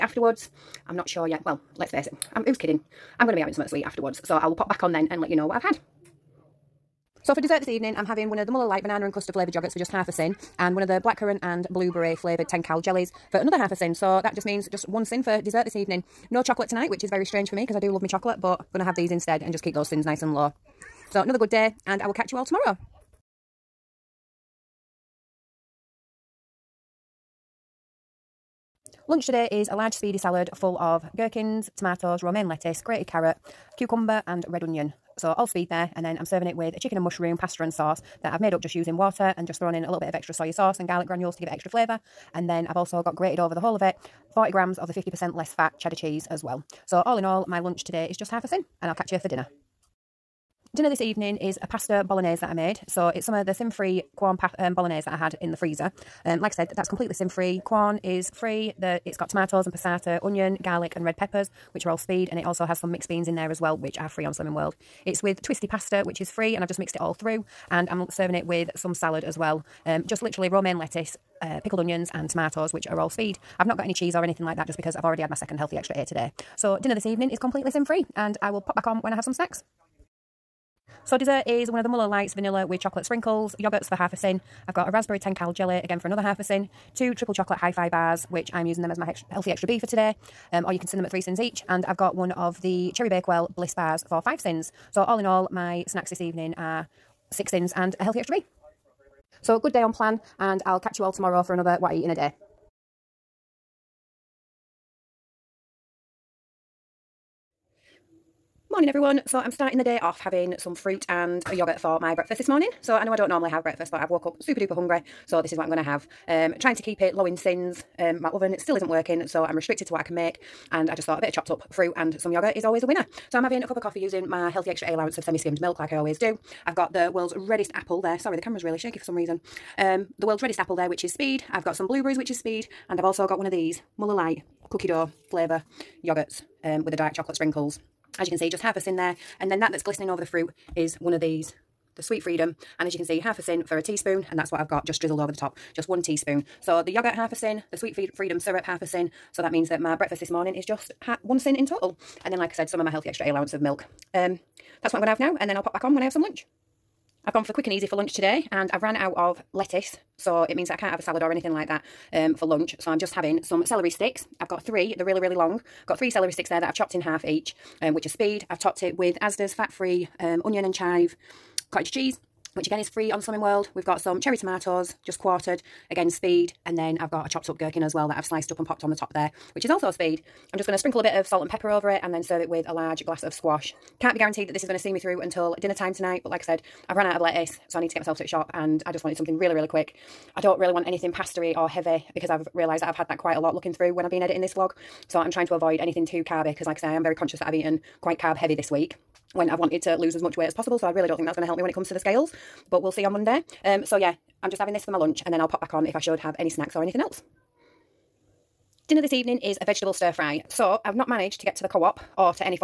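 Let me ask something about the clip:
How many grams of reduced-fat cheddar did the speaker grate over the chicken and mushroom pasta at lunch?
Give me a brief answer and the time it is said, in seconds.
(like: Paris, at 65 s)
40 grams, at 44 s.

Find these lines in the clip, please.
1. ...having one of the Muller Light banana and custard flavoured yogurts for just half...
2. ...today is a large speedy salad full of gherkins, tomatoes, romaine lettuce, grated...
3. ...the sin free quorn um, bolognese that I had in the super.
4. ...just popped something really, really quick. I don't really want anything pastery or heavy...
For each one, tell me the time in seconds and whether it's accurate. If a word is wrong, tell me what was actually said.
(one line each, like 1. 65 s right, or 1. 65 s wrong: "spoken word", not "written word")
1. 8 s right
2. 29 s right
3. 53 s wrong: "freezer", not "super"
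4. 188 s wrong: "wanted", not "popped".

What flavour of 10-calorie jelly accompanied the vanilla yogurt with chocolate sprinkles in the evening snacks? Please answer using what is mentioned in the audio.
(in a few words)
Raspberry.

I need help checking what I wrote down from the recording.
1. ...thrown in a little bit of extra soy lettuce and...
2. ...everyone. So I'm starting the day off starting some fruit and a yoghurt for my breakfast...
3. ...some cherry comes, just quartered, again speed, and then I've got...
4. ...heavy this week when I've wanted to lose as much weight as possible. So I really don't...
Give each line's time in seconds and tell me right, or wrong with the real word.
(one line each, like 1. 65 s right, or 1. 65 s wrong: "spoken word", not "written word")
1. 39 s wrong: "sauce", not "lettuce"
2. 108 s wrong: "having", not "starting"
3. 173 s wrong: "tomatoes", not "comes"
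4. 198 s right.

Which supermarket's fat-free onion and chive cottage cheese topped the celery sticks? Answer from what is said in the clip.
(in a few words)
Asda.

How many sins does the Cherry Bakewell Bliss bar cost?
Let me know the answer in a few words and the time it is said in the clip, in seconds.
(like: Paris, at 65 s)
5, at 94 s.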